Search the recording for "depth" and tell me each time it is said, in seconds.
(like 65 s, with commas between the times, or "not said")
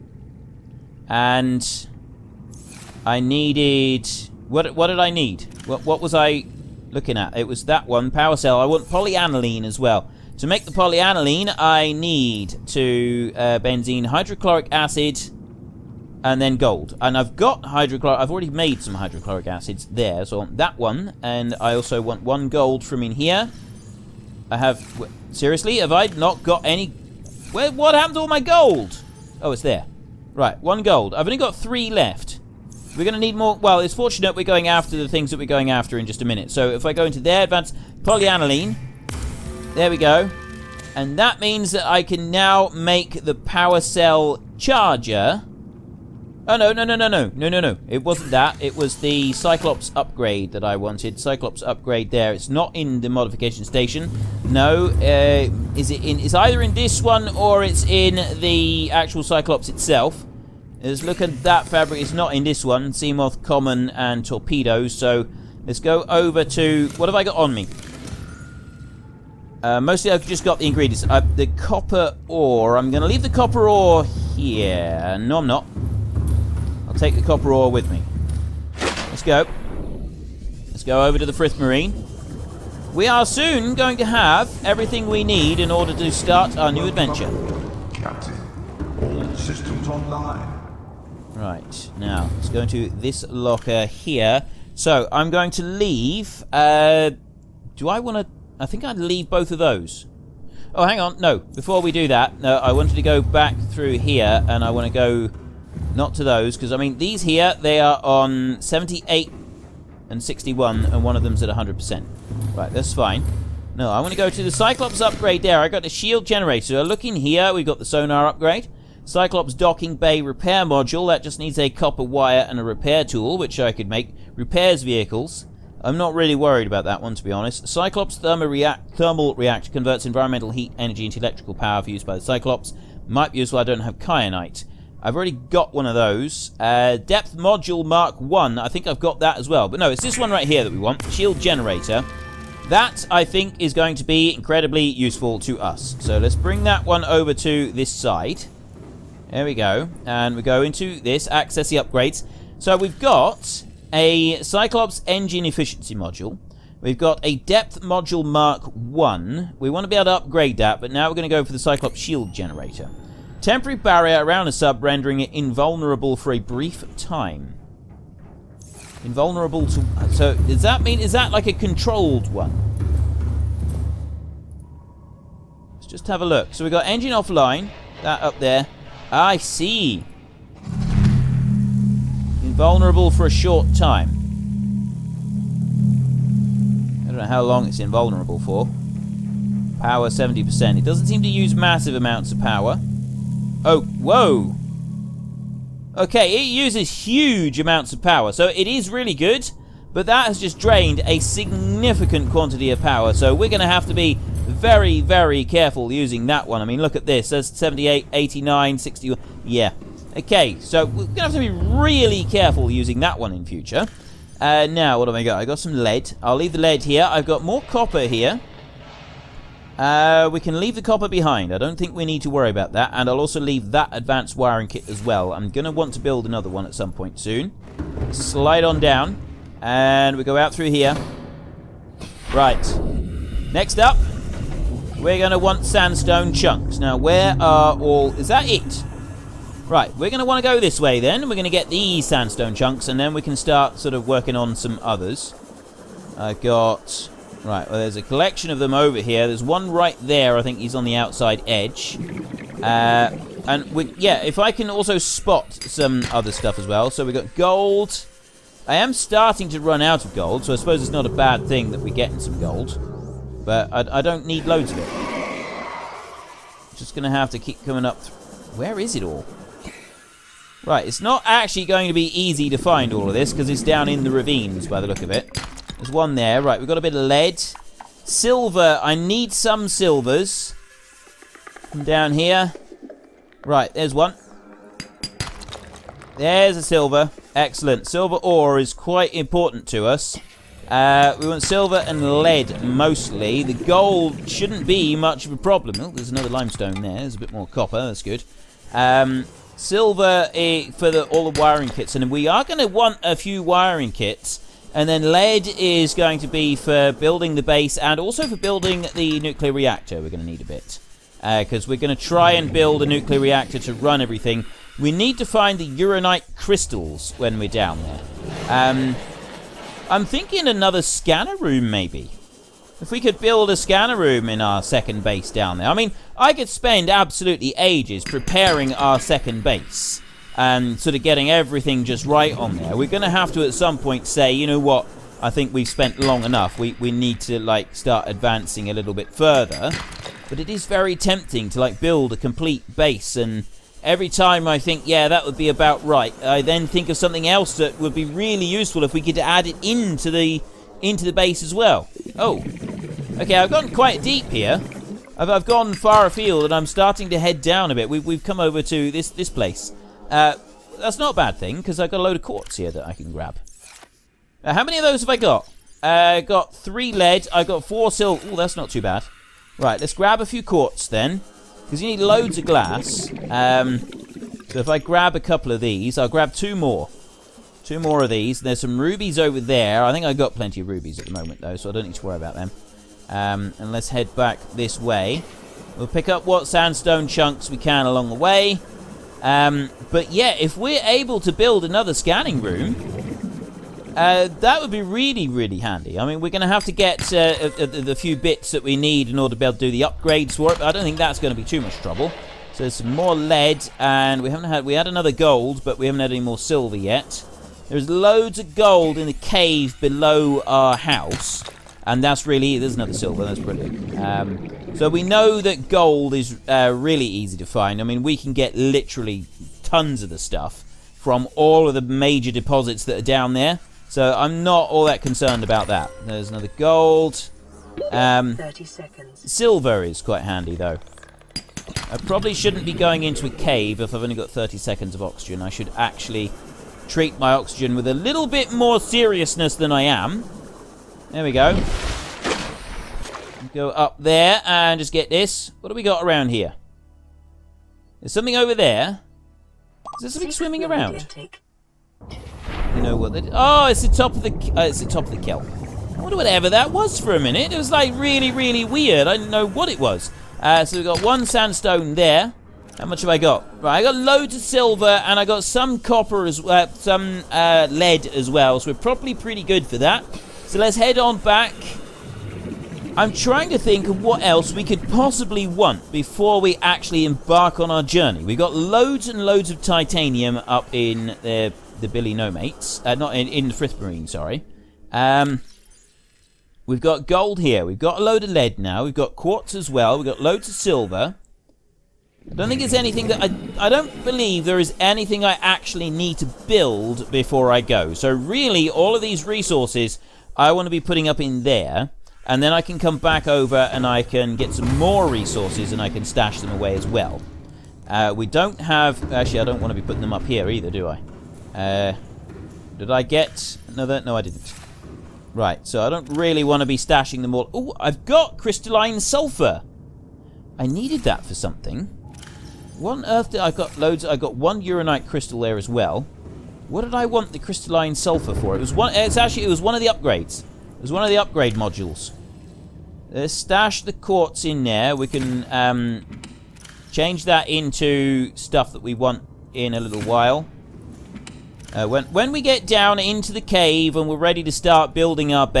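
136 s, 157 s.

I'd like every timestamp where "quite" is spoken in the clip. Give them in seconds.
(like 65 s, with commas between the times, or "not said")
288 s, 353 s, 429 s.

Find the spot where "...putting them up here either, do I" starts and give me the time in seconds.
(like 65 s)
509 s.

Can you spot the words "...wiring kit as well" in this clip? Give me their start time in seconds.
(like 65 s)
224 s.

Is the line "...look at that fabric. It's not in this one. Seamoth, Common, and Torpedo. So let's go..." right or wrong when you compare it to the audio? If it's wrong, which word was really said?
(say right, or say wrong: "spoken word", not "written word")
right.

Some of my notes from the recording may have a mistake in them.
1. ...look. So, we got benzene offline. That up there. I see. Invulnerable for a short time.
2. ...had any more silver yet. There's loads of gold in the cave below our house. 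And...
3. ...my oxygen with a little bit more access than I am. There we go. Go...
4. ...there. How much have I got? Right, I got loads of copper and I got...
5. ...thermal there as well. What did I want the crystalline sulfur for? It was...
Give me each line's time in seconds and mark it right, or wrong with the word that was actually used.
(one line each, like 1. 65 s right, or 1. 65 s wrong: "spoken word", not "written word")
1. 176 s wrong: "engine", not "benzene"
2. 406 s right
3. 437 s wrong: "seriousness", not "access"
4. 461 s wrong: "silver", not "copper"
5. 525 s wrong: "crystal", not "thermal".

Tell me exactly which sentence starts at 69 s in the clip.
Uh, mostly I've just got the ingredients.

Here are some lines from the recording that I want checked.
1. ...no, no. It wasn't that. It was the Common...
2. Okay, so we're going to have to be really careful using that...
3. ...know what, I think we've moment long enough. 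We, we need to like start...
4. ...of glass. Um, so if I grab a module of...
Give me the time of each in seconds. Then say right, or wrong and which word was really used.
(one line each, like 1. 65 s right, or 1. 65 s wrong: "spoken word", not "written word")
1. 47 s wrong: "Cyclops", not "Common"
2. 210 s right
3. 334 s wrong: "spent", not "moment"
4. 372 s wrong: "couple", not "module".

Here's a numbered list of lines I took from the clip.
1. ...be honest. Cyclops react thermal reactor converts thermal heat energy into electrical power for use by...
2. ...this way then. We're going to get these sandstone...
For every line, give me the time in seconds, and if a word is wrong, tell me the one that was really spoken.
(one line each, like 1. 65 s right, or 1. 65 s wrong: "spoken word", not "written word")
1. 127 s wrong: "environmental", not "thermal"
2. 240 s right.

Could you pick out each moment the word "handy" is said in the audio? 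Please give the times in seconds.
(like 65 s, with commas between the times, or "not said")
395 s, 430 s.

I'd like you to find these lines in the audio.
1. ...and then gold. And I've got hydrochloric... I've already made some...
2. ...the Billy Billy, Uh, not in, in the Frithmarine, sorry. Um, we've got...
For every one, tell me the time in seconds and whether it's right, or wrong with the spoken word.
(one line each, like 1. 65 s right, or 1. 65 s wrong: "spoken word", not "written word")
1. 16 s right
2. 481 s wrong: "Nomates", not "Billy".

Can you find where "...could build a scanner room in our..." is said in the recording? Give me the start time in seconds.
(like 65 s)
322 s.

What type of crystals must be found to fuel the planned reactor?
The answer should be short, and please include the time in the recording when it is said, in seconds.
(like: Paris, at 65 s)
Uranite crystals, at 315 s.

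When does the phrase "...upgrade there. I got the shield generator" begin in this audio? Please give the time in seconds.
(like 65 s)
114 s.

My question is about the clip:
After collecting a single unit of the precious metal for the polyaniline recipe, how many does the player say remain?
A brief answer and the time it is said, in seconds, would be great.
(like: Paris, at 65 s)
3, at 31 s.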